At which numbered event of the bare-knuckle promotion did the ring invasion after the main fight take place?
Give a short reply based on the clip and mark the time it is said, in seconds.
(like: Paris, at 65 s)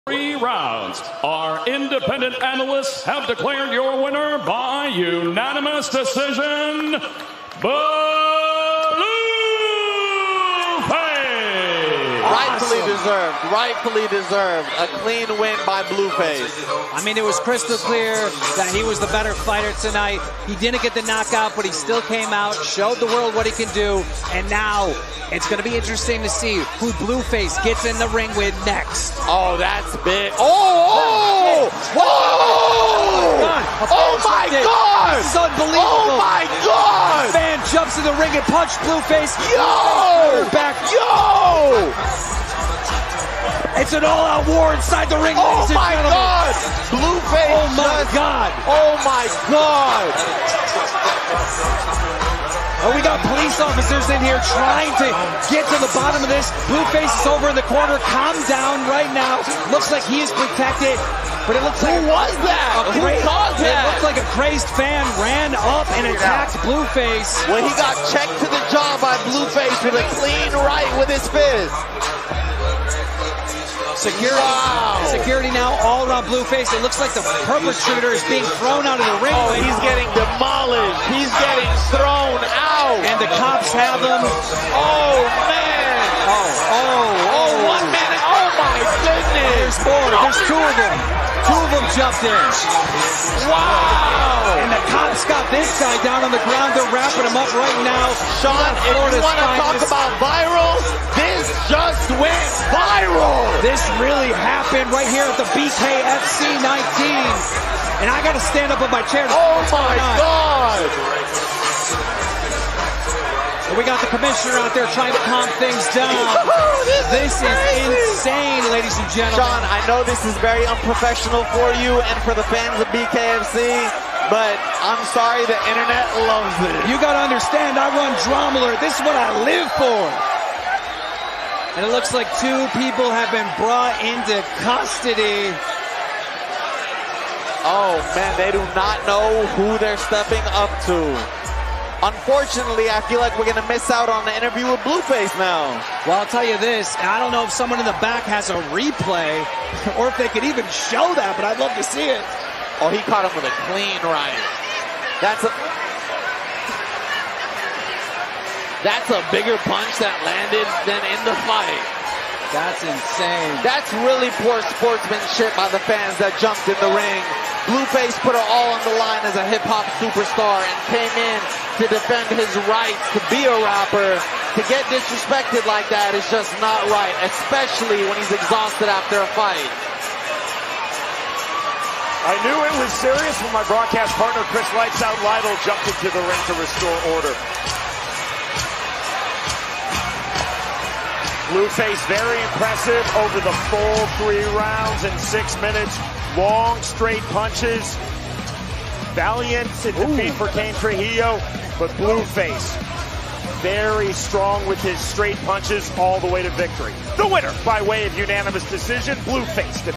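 BKFC 19, at 105 s.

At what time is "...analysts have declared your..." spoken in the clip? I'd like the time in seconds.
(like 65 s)
2 s.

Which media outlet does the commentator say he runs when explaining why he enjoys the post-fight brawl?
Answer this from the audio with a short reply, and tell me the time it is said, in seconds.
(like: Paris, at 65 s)
DramaAlert, at 128 s.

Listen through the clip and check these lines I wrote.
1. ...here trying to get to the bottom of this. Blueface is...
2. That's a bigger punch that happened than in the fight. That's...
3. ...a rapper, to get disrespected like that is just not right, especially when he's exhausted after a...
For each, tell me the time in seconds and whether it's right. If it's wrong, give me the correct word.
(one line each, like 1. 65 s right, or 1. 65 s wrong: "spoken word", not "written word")
1. 54 s right
2. 158 s wrong: "landed", not "happened"
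3. 173 s right.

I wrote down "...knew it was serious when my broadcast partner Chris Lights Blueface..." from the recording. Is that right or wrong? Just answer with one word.
wrong.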